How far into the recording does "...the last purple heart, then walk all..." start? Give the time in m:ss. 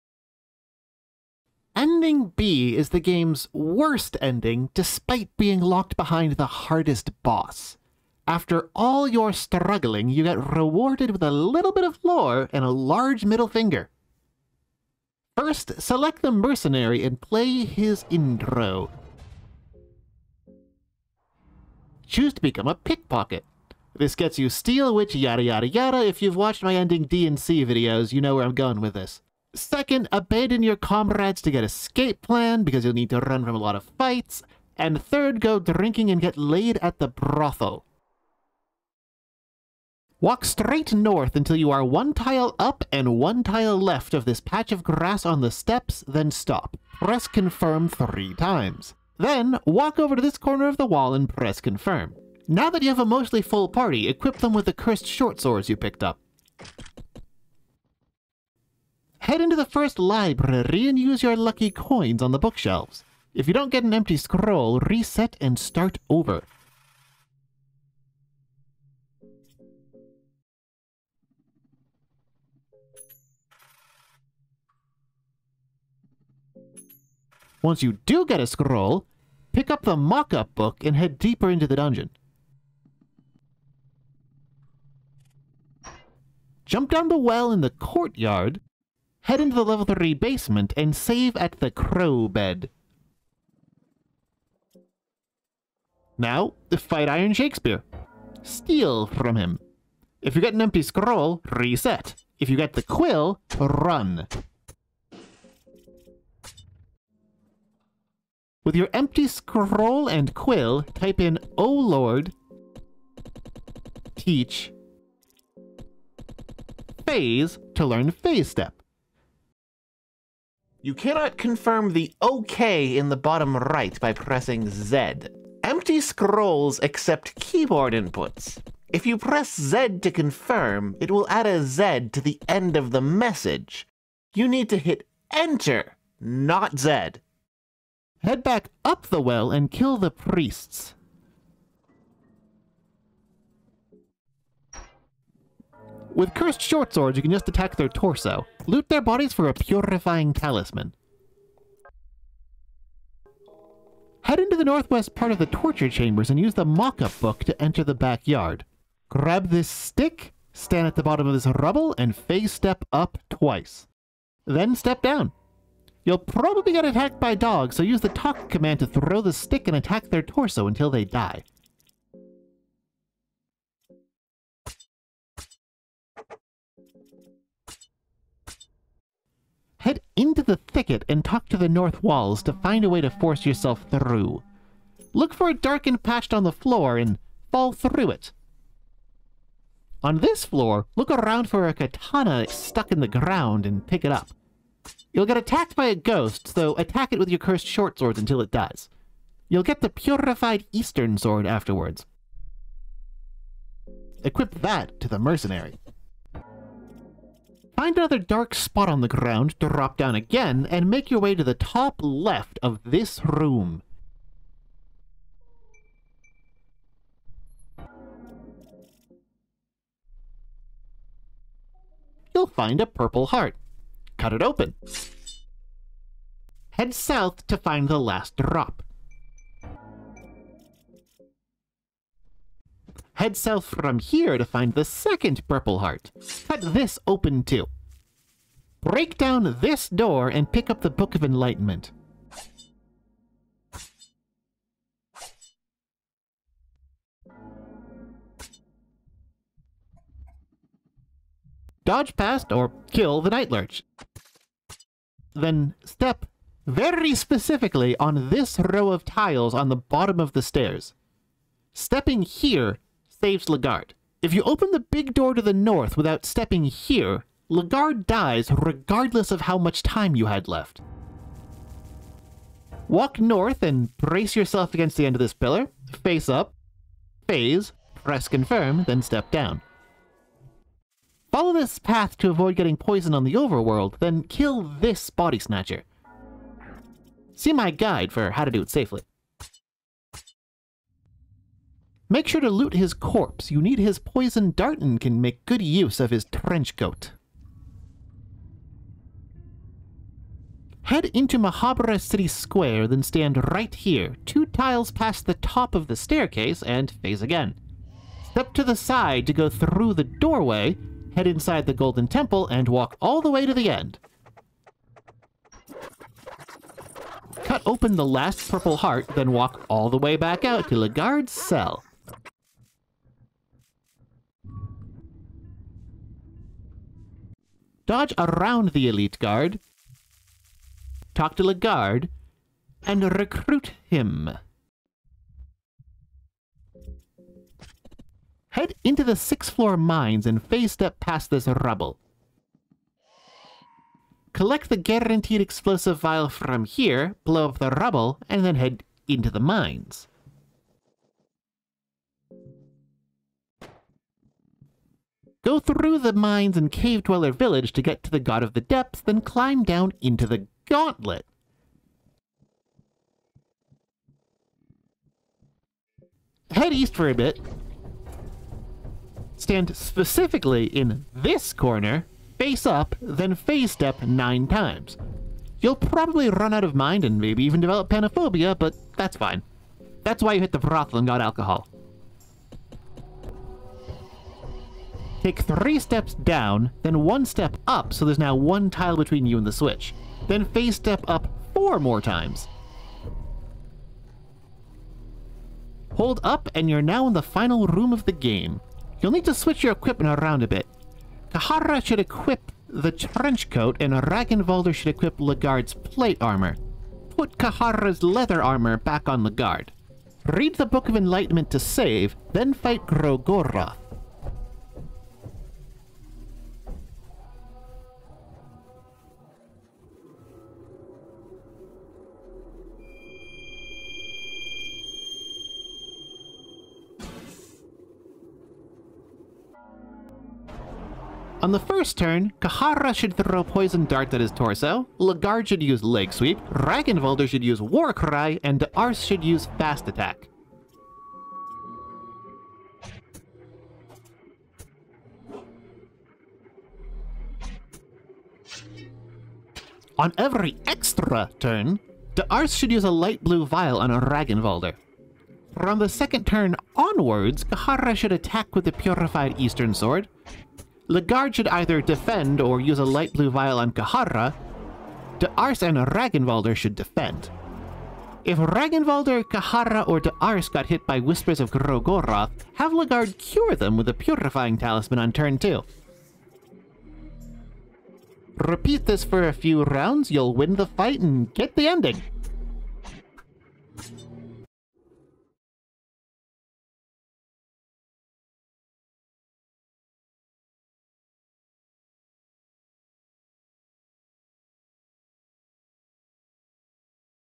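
5:17.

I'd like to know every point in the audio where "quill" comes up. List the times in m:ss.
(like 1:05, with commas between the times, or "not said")
1:42, 1:50.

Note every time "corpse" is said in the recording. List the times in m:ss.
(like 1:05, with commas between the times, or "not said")
4:52.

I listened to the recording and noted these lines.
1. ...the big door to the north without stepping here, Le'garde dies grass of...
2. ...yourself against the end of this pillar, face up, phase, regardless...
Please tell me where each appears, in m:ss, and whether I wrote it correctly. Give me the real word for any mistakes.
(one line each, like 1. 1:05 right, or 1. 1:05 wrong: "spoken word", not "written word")
1. 4:24 wrong: "regardless", not "grass"
2. 4:34 wrong: "press", not "regardless".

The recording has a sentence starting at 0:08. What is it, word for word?
After all your struggling, you get rewarded with a little bit of lore and a large middle finger.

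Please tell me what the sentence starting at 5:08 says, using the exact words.
Step to the side to go through the doorway, head inside the Golden Temple, and walk all the way to the end.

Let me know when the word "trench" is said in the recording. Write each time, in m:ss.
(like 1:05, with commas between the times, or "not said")
4:56, 6:42.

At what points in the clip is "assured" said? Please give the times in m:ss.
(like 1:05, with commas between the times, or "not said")
not said.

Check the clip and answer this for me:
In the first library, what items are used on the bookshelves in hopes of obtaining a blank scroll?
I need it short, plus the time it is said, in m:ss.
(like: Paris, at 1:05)
Lucky coins, at 1:01.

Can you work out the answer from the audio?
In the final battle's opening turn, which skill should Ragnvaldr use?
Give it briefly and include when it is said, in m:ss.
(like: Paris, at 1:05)
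War Cry, at 7:17.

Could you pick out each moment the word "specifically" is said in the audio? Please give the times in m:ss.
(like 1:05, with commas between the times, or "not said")
4:17, 6:09.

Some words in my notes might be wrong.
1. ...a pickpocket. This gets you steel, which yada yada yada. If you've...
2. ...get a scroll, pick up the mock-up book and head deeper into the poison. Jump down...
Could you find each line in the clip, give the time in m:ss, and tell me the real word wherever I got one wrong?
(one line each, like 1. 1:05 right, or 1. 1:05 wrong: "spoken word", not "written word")
1. 0:22 right
2. 1:18 wrong: "dungeon", not "poison".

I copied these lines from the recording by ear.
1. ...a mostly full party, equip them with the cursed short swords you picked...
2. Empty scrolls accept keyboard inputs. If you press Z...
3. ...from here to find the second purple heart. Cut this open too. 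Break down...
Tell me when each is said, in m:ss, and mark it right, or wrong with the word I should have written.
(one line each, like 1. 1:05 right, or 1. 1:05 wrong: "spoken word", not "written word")
1. 0:52 right
2. 2:05 right
3. 3:53 right.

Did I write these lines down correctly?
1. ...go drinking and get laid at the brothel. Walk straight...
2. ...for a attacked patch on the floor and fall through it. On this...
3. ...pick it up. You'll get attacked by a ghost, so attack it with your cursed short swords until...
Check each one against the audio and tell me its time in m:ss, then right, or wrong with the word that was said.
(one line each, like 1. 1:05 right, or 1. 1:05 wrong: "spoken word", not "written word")
1. 0:35 right
2. 3:05 wrong: "darkened", not "attacked"
3. 3:13 right.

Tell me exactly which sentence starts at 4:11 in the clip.
Dodge past or kill the Night Lurch.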